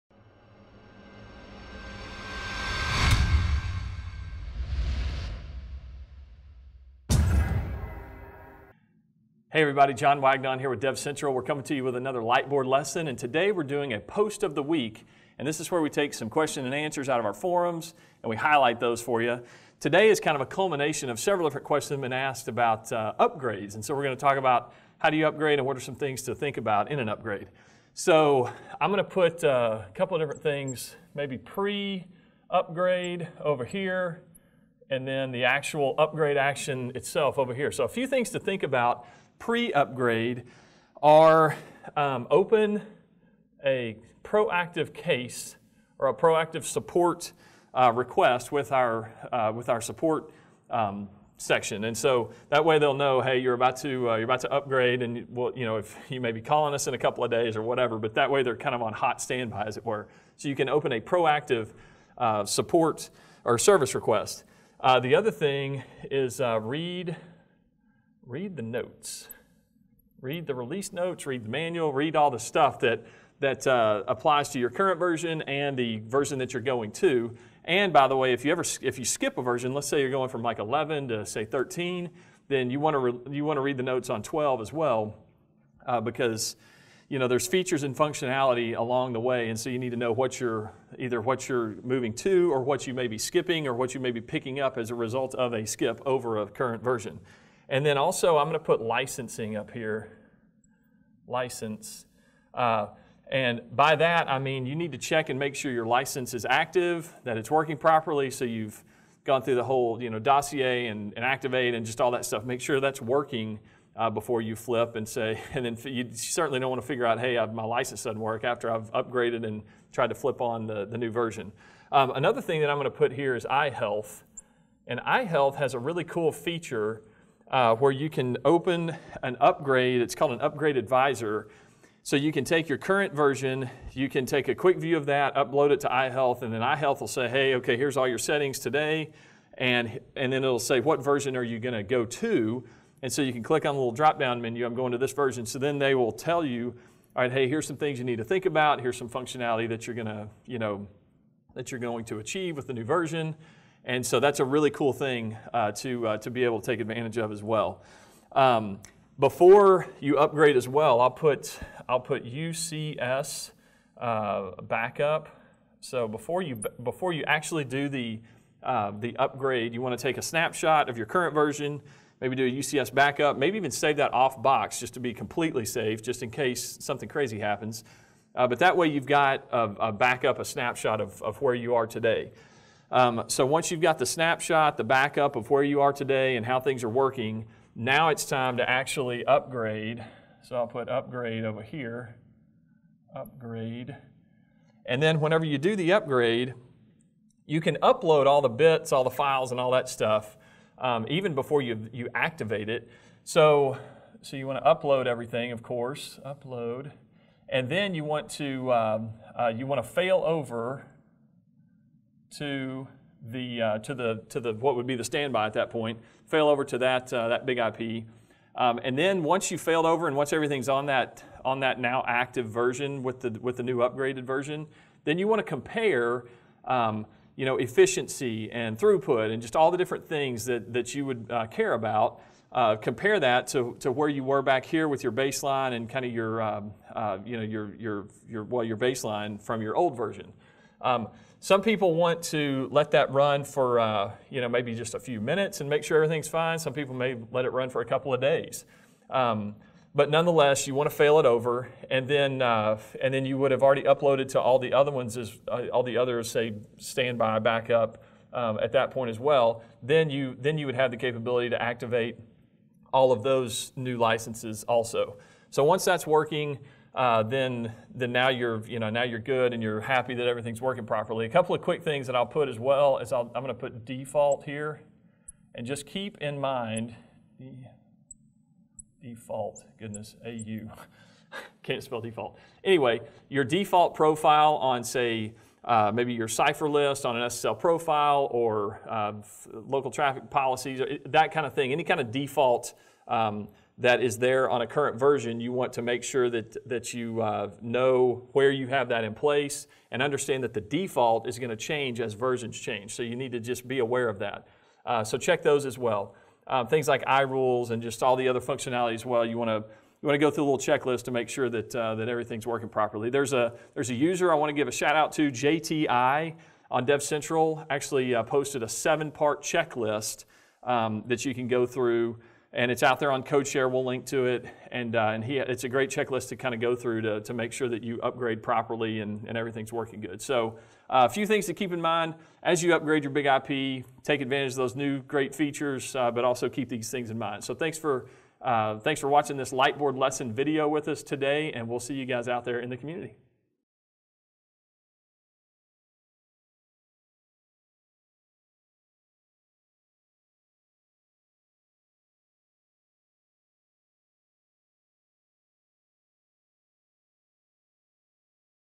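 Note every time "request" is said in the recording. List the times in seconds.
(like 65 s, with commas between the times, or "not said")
47 s, 63 s.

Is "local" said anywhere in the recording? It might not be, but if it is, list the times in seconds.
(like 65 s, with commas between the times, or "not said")
289 s.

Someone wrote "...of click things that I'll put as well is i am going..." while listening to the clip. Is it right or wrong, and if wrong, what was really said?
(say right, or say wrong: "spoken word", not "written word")
wrong: "quick", not "click".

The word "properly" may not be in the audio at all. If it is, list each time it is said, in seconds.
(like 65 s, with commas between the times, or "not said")
107 s, 270 s, 312 s, 328 s.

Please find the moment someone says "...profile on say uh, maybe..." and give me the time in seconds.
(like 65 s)
283 s.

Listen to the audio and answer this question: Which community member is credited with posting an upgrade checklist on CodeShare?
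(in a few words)
JTI.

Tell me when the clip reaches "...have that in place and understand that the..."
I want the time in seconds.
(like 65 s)
298 s.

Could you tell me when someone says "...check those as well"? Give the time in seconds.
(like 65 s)
305 s.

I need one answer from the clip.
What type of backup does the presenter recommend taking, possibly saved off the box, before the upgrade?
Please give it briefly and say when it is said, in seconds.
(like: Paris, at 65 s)
UCS backup, at 162 s.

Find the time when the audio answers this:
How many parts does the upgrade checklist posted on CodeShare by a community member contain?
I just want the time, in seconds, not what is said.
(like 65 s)
318 s.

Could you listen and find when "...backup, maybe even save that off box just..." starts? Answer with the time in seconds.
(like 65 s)
172 s.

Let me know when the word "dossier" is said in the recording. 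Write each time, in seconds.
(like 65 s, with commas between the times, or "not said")
110 s.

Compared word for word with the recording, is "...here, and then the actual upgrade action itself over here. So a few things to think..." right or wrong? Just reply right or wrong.
right.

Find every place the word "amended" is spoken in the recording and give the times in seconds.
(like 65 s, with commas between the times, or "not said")
not said.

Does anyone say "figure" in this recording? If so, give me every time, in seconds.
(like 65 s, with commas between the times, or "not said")
116 s.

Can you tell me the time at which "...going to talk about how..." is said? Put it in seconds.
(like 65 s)
24 s.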